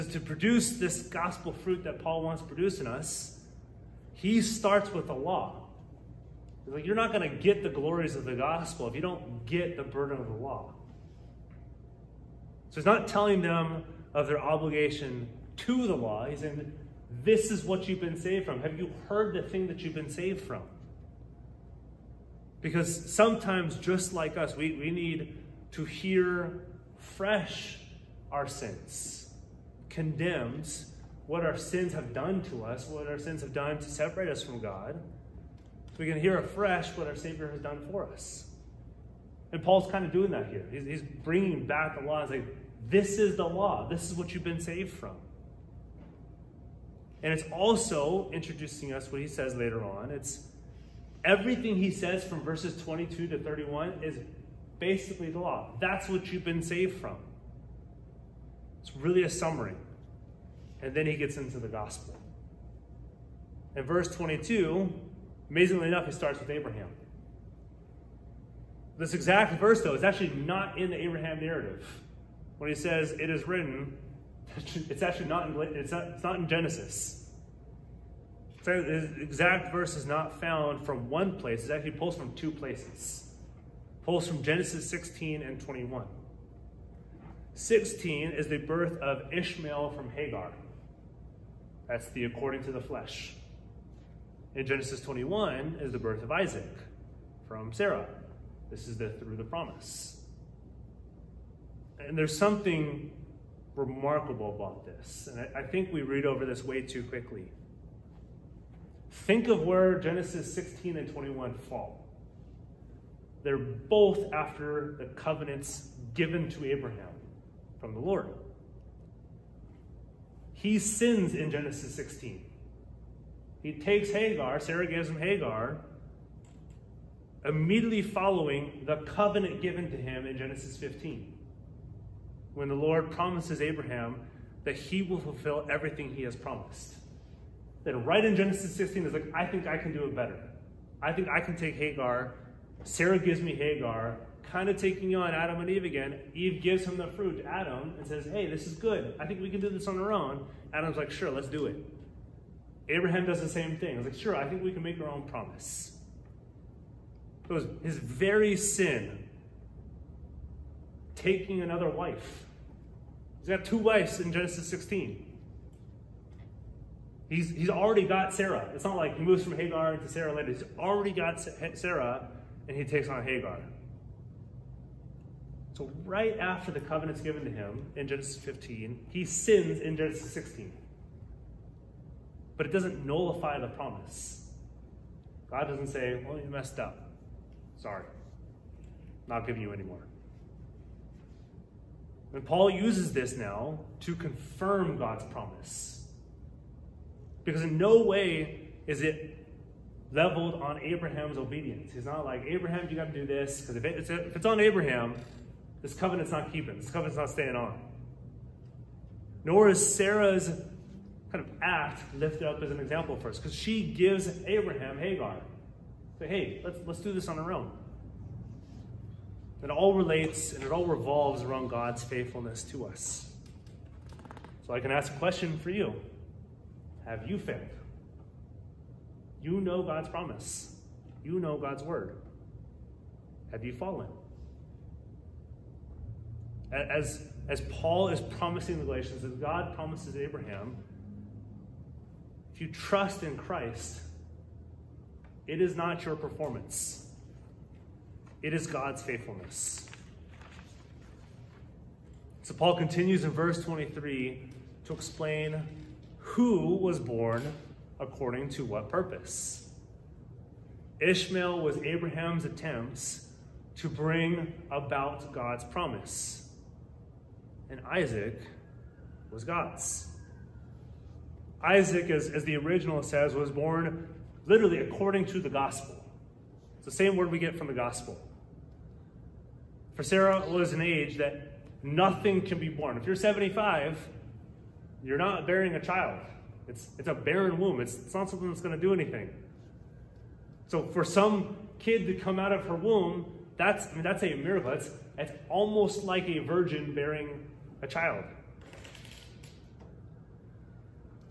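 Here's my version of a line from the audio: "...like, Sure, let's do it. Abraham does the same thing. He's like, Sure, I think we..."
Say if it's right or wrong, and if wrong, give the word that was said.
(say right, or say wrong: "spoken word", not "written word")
right.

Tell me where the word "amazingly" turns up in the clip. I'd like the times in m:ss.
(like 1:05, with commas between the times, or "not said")
1:05.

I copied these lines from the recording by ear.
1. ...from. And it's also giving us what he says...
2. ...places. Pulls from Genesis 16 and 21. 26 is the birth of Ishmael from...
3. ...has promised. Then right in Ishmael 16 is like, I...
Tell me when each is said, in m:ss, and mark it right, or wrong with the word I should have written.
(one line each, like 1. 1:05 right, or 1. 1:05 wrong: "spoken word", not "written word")
1. 0:44 wrong: "introducing", not "giving"
2. 1:22 wrong: "16", not "26"
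3. 2:16 wrong: "Genesis", not "Ishmael".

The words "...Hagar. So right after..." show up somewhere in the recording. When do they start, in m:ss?
2:53.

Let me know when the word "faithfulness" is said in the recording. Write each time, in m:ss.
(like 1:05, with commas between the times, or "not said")
3:42, 4:09.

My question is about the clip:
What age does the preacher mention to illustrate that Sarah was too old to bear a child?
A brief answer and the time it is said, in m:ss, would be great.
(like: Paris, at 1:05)
75, at 4:43.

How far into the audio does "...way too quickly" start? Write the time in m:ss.
1:46.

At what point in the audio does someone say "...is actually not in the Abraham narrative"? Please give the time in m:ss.
1:09.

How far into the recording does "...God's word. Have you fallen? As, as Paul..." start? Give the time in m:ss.
3:51.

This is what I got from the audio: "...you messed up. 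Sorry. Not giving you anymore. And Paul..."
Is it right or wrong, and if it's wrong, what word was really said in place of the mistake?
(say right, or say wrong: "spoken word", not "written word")
right.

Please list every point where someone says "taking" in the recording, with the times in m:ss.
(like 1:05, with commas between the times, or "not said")
2:24, 2:41.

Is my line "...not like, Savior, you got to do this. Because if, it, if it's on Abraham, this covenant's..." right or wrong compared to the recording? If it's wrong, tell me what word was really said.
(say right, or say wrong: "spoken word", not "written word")
wrong: "Abraham", not "Savior".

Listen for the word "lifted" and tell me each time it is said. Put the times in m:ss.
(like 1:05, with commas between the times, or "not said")
3:32.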